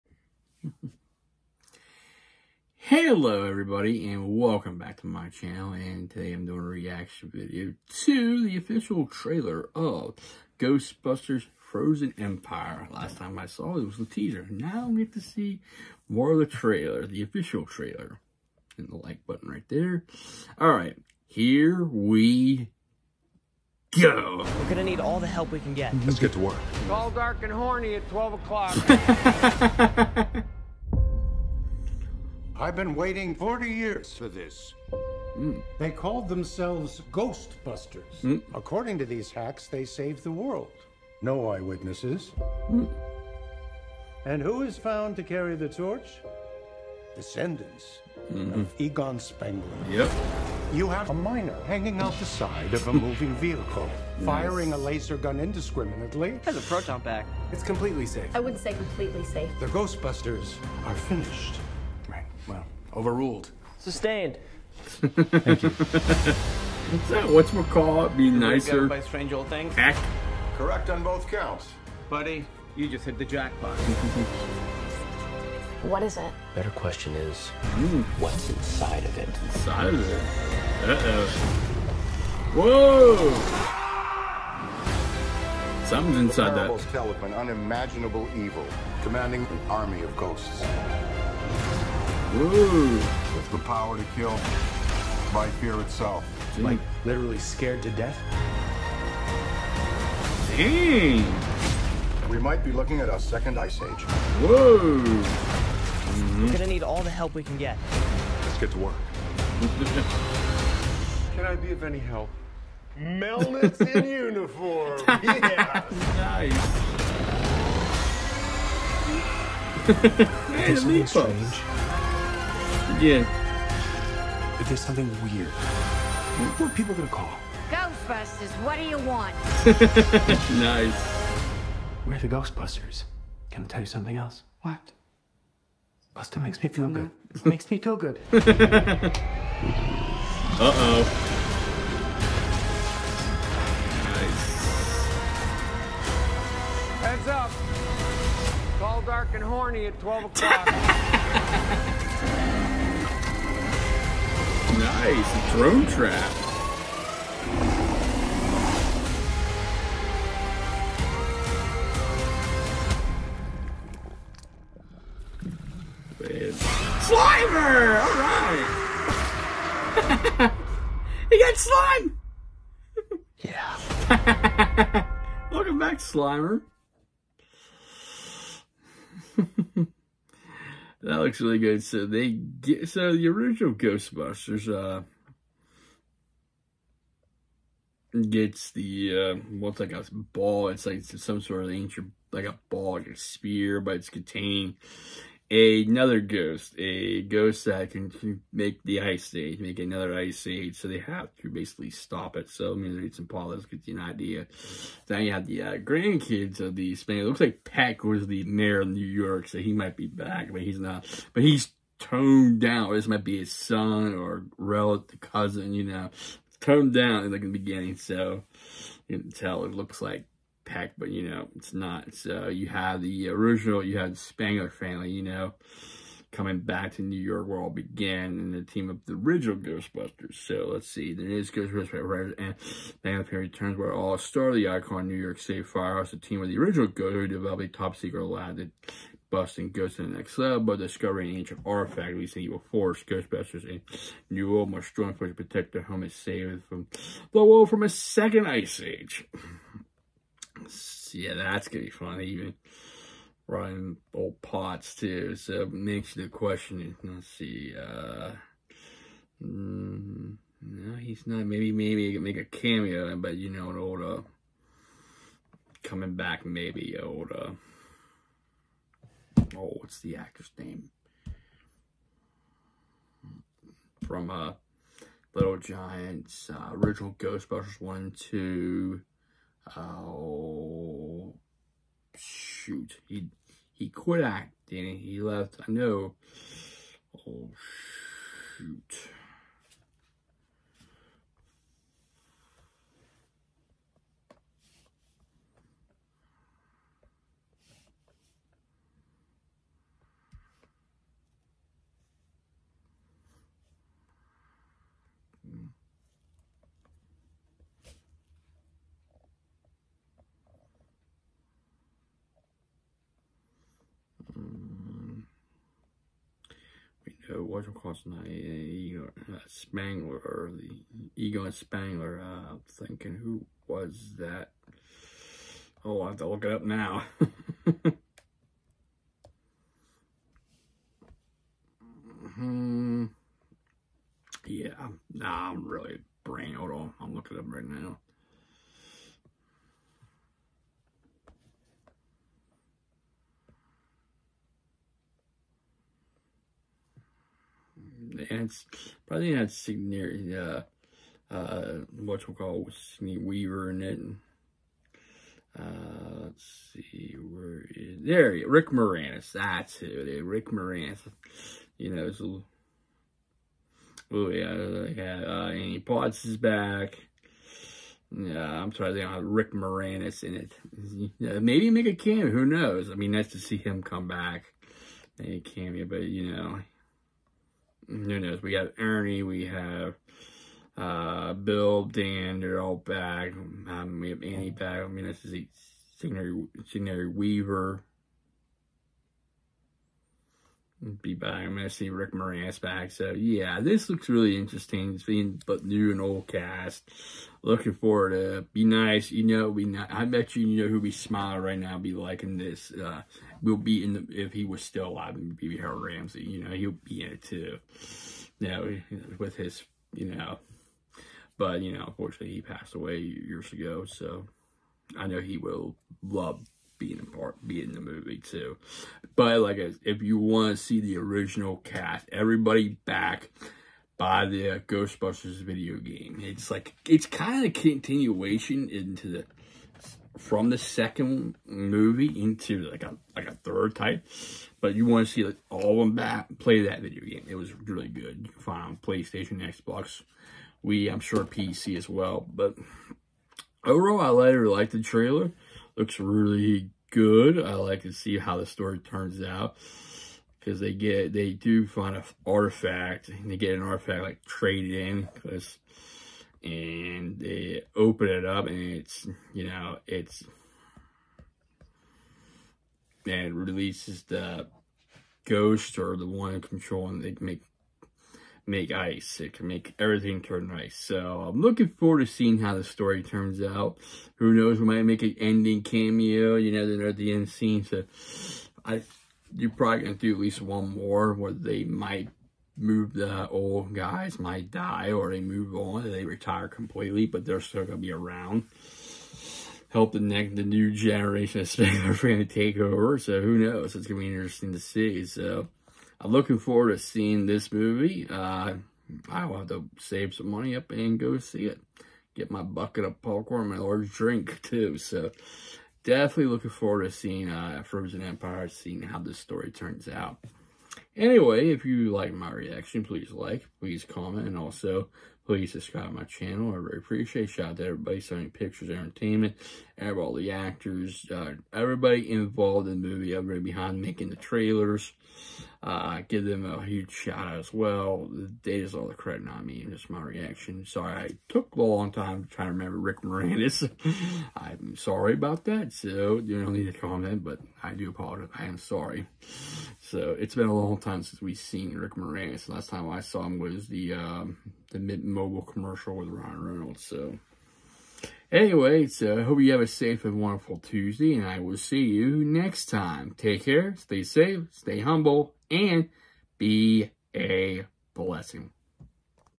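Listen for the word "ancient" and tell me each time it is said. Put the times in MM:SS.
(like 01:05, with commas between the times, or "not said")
03:11, 04:01.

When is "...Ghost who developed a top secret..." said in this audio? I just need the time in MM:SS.
03:56.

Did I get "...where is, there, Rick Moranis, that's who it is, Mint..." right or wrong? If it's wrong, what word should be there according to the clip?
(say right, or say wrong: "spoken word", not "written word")
wrong: "Rick", not "Mint".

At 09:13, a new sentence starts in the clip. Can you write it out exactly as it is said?
Take care, stay safe, stay humble, and be a blessing.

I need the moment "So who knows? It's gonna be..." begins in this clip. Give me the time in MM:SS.
08:12.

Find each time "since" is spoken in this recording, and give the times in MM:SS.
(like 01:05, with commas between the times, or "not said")
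09:01.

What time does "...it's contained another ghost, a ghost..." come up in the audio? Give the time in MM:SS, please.
03:13.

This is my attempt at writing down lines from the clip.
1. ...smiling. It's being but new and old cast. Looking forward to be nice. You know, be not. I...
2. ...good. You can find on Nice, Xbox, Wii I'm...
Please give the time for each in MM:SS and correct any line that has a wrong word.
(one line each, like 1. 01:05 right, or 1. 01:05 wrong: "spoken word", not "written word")
1. 06:34 wrong: "interesting", not "smiling"
2. 07:17 wrong: "PlayStation", not "Nice".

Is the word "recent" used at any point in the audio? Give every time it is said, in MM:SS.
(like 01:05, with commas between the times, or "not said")
not said.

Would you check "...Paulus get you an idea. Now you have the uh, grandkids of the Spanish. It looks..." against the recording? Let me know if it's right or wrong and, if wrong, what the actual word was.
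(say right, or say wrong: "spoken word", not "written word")
right.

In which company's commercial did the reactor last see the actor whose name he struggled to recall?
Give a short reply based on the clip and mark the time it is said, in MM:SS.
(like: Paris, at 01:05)
Mint Mobile, at 09:04.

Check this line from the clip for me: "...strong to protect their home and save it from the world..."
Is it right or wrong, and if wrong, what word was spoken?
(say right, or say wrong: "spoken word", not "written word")
right.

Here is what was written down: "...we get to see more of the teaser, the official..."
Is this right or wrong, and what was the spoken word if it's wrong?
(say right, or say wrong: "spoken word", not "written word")
wrong: "trailer", not "teaser".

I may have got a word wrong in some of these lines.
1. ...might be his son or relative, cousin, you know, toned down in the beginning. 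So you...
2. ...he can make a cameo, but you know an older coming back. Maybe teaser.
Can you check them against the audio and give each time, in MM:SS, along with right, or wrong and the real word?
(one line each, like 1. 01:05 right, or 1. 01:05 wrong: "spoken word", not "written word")
1. 03:33 right
2. 04:22 wrong: "older", not "teaser".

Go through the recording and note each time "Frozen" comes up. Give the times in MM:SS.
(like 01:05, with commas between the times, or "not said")
00:11, 08:27.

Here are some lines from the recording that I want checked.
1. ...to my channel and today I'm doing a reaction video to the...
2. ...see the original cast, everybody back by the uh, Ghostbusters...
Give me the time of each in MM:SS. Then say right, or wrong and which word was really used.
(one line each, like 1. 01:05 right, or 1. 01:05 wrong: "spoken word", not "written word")
1. 00:04 right
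2. 07:00 right.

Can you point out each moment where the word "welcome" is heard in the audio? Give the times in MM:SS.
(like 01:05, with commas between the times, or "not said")
00:04, 02:55.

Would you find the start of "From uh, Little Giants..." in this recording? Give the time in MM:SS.
04:34.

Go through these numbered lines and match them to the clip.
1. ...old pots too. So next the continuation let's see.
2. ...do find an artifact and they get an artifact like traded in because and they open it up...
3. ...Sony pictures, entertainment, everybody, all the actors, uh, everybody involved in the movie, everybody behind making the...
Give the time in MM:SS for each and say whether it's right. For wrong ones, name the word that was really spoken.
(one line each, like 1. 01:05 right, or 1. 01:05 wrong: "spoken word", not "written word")
1. 04:14 wrong: "question", not "continuation"
2. 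07:31 right
3. 08:37 right.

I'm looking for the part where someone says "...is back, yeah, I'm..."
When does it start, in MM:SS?
06:06.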